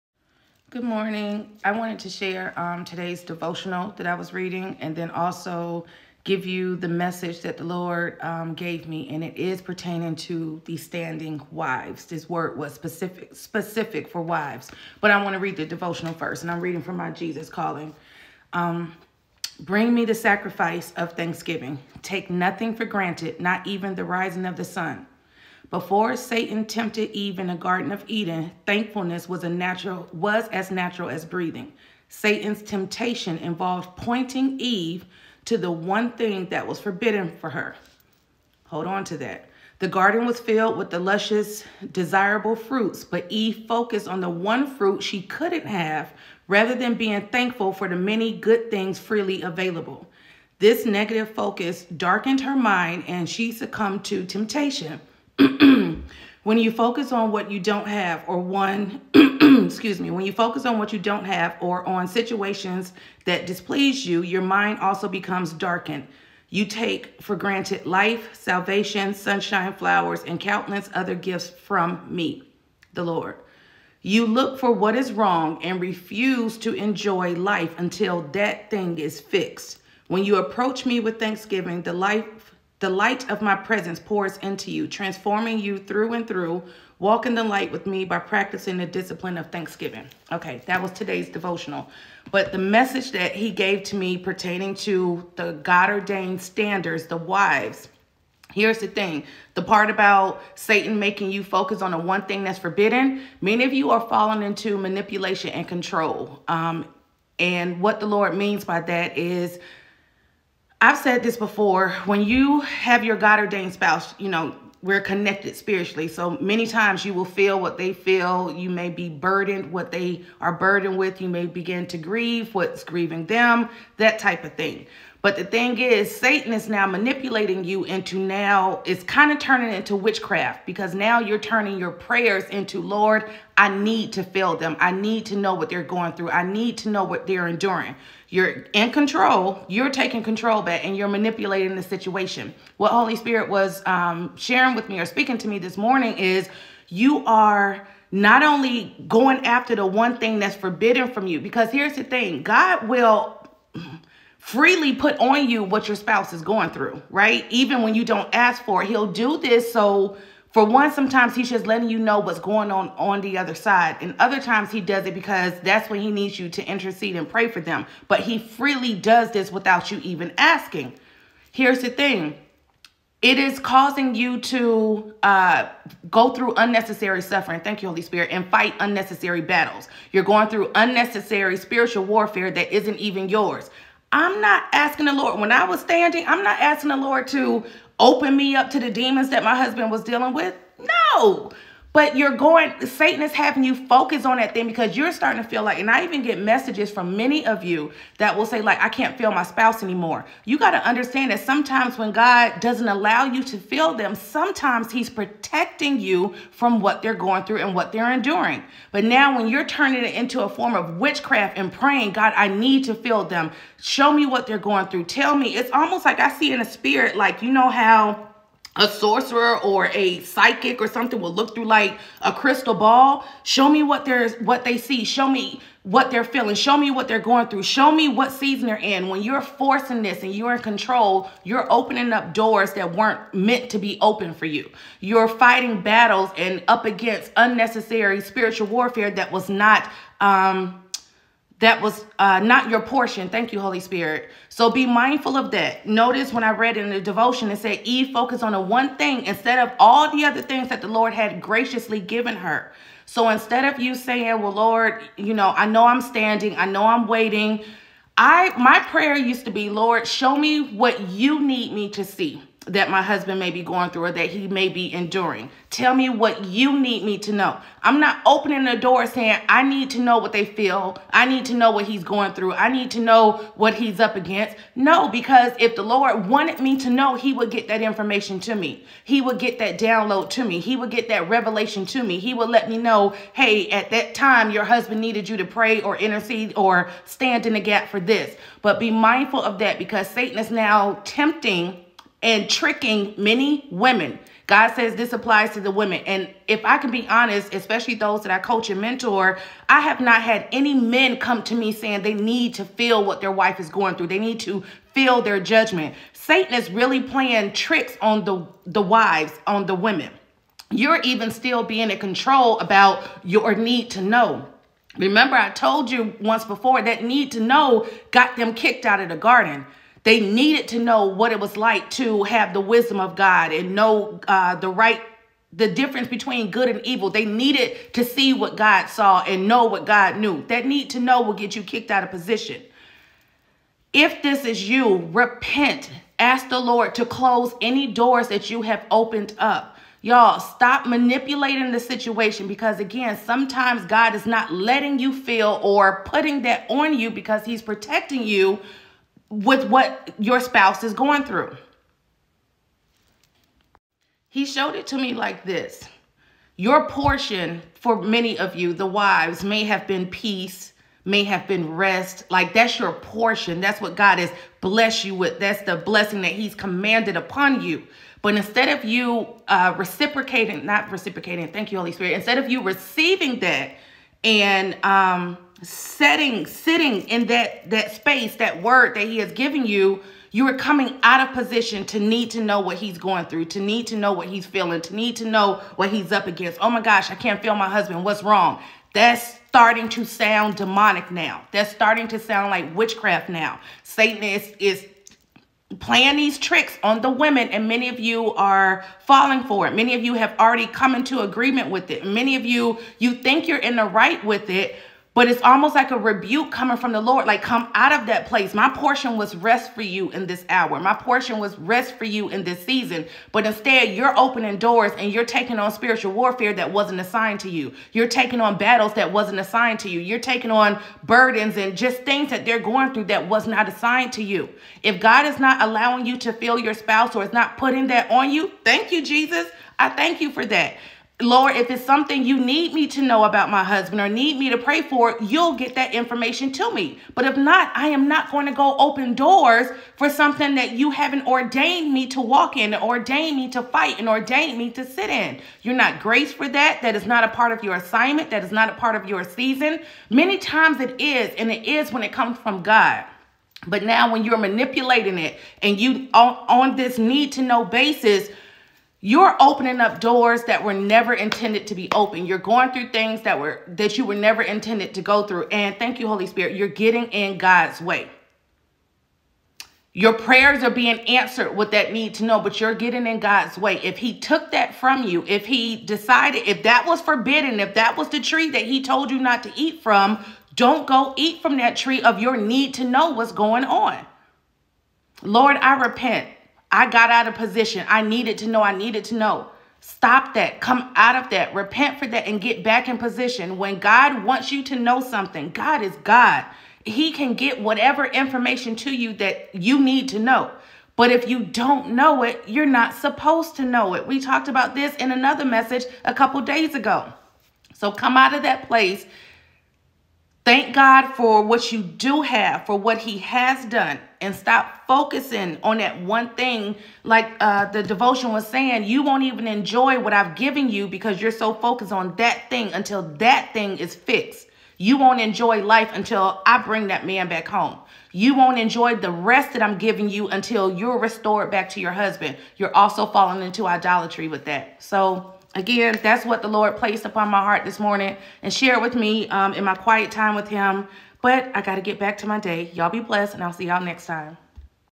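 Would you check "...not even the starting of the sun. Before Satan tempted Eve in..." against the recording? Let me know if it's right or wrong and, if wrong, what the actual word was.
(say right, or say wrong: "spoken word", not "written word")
wrong: "rising", not "starting".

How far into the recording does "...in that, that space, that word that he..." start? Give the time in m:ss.
6:17.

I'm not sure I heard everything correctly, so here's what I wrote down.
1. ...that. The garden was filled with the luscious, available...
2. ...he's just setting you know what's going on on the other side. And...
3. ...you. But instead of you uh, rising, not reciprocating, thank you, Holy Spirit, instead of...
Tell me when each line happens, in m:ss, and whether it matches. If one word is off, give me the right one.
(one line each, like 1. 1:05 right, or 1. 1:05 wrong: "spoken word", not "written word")
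1. 0:39 wrong: "desirable", not "available"
2. 2:41 wrong: "letting", not "setting"
3. 6:07 wrong: "reciprocating", not "rising".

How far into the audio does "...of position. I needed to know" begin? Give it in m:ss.
8:07.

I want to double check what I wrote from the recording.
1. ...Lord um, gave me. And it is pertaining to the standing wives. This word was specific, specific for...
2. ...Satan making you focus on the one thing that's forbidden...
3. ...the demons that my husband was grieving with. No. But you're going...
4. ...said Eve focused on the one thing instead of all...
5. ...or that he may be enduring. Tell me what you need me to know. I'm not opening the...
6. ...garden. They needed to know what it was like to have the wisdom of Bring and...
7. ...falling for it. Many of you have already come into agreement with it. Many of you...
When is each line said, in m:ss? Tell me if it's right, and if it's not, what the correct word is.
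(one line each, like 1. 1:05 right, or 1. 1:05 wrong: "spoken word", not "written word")
1. 0:07 right
2. 1:40 right
3. 3:08 wrong: "dealing", not "grieving"
4. 4:07 right
5. 4:24 right
6. 5:19 wrong: "God", not "Bring"
7. 6:39 right.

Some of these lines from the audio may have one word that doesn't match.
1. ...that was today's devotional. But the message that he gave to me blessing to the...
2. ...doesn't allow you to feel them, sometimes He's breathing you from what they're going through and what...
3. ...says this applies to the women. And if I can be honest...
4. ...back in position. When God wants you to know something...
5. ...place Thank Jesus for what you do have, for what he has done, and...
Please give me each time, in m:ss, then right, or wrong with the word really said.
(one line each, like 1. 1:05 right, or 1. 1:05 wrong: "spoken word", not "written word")
1. 1:30 wrong: "pertaining", not "blessing"
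2. 3:22 wrong: "protecting", not "breathing"
3. 4:54 right
4. 8:12 right
5. 8:28 wrong: "God", not "Jesus".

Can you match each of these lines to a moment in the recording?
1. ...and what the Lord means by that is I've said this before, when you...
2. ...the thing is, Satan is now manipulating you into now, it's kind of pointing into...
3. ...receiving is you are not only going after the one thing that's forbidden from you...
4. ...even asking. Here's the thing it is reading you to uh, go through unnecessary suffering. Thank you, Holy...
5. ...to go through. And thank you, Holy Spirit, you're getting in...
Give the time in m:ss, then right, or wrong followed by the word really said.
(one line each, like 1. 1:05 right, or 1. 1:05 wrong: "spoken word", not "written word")
1. 1:47 right
2. 2:05 wrong: "turning", not "pointing"
3. 2:25 wrong: "morning", not "receiving"
4. 2:50 wrong: "causing", not "reading"
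5. 7:44 right.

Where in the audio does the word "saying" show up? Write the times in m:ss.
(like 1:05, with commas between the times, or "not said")
4:13, 4:29, 5:01, 8:38.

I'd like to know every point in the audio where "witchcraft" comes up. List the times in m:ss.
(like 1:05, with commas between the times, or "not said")
2:09, 3:30, 6:32.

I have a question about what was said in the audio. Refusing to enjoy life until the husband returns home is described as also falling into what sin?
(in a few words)
idolatry.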